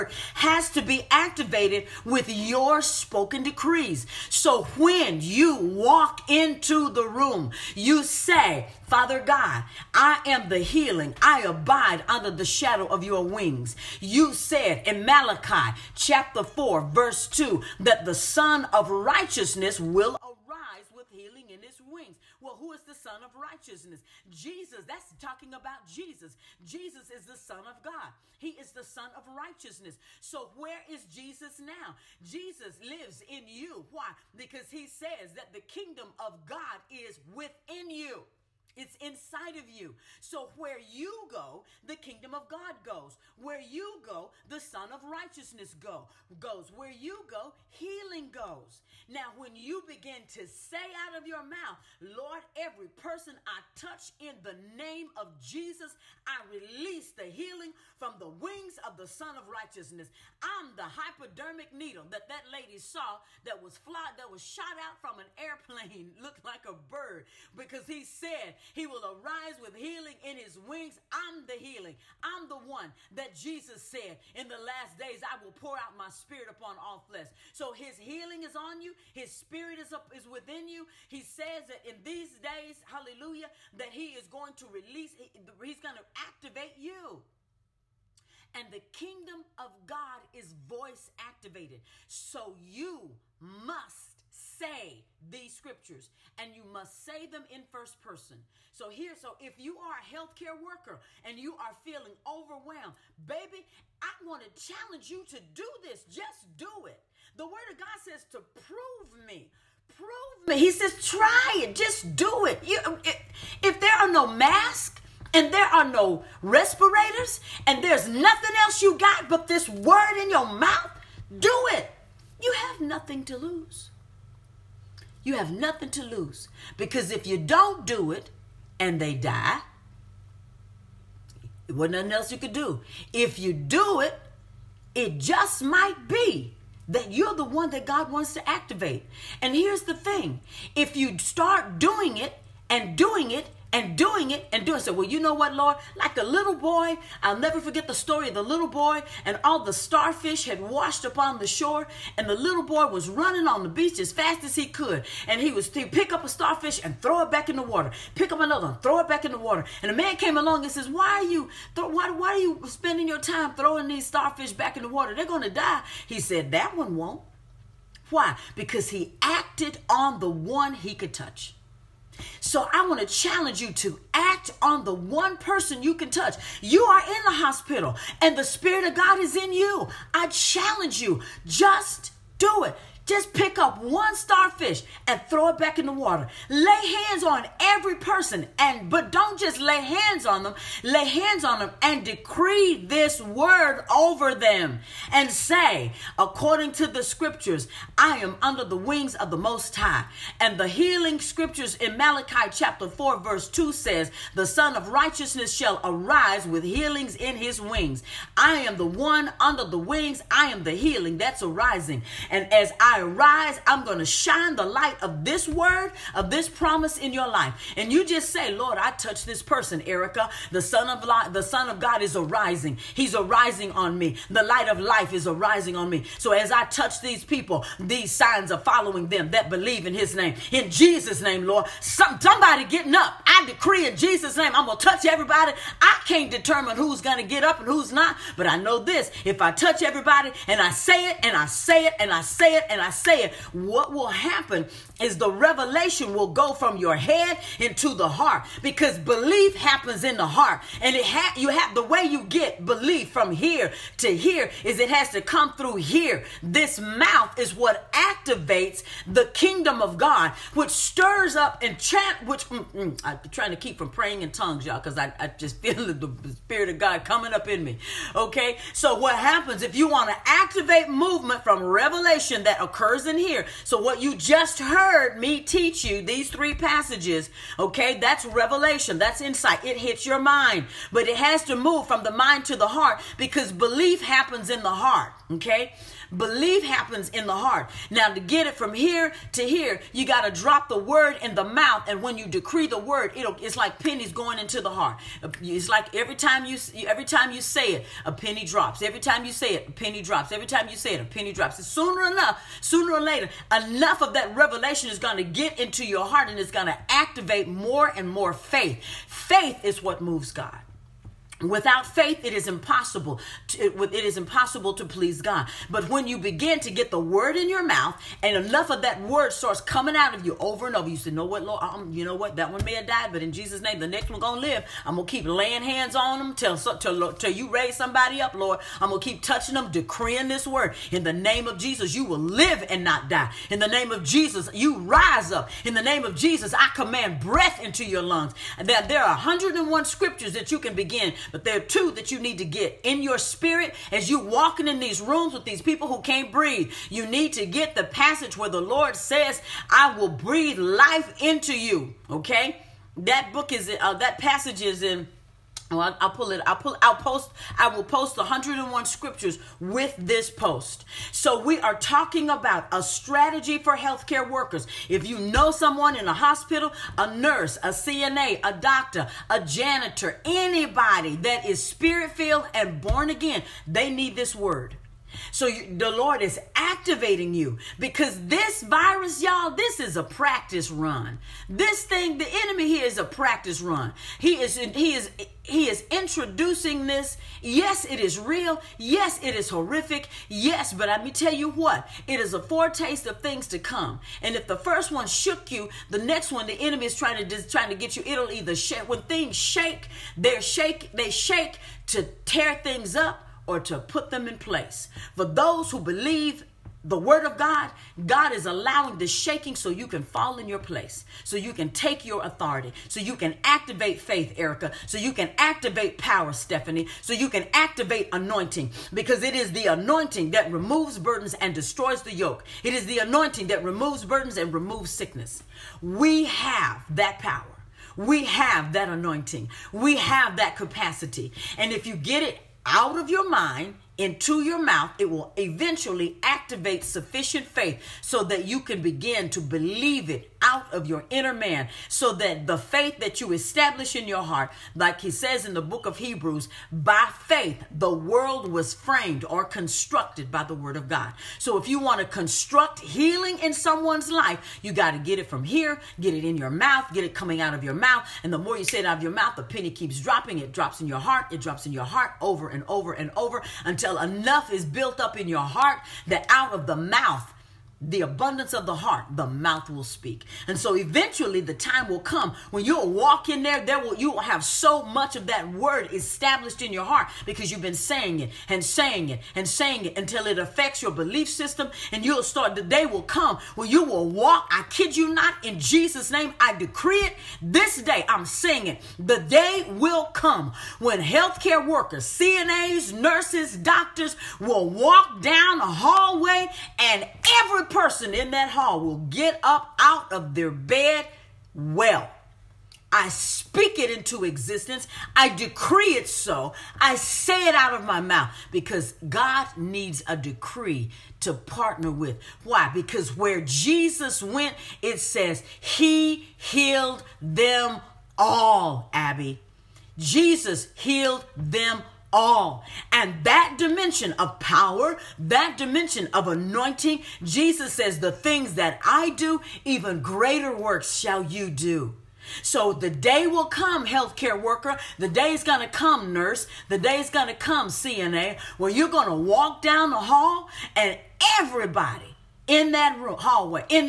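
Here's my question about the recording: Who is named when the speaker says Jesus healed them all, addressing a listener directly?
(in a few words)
Abby.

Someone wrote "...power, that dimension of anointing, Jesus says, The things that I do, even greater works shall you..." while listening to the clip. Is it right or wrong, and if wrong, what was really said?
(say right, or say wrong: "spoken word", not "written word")
right.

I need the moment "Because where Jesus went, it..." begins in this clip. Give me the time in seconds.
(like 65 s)
512 s.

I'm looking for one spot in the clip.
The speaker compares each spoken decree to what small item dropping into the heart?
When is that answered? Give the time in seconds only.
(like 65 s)
293 s.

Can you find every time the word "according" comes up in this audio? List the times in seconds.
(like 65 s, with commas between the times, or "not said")
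196 s.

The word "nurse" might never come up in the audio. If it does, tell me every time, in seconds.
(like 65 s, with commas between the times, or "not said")
367 s, 492 s, 536 s.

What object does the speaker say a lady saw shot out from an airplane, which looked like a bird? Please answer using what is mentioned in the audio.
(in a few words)
Hypodermic needle.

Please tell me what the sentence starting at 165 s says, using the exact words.
They're going to die." He said, "That one won't." Why?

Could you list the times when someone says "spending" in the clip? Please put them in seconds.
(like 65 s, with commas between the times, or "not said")
162 s.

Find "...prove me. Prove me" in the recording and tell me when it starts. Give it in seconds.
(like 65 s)
108 s.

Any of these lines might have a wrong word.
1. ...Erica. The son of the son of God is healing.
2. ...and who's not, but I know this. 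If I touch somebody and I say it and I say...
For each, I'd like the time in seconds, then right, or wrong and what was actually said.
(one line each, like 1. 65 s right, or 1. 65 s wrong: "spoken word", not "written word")
1. 219 s wrong: "arising", not "healing"
2. 237 s wrong: "everybody", not "somebody".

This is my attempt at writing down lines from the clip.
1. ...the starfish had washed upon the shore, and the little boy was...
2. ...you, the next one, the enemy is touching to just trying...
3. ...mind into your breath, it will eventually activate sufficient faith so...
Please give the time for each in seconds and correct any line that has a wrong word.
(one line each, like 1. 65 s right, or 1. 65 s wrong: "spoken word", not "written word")
1. 149 s right
2. 395 s wrong: "trying", not "touching"
3. 433 s wrong: "mouth", not "breath".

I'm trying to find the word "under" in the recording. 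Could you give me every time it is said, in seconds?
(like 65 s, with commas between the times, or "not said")
12 s, 198 s, 209 s.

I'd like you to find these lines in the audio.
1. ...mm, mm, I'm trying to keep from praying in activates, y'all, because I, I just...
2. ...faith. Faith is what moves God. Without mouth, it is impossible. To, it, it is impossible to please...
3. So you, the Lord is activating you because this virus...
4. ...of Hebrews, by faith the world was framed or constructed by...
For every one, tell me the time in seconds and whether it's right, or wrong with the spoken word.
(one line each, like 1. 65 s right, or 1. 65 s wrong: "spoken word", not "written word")
1. 262 s wrong: "tongues", not "activates"
2. 308 s wrong: "faith", not "mouth"
3. 375 s right
4. 445 s right.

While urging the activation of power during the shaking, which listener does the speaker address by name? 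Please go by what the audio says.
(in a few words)
Stephanie.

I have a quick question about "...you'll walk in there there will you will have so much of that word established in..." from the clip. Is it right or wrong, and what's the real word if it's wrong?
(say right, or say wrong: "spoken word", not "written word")
right.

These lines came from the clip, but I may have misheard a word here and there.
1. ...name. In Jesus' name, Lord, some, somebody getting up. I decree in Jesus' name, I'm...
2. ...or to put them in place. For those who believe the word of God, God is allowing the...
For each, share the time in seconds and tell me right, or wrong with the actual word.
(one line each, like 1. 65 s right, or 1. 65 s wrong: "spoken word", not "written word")
1. 230 s right
2. 403 s right.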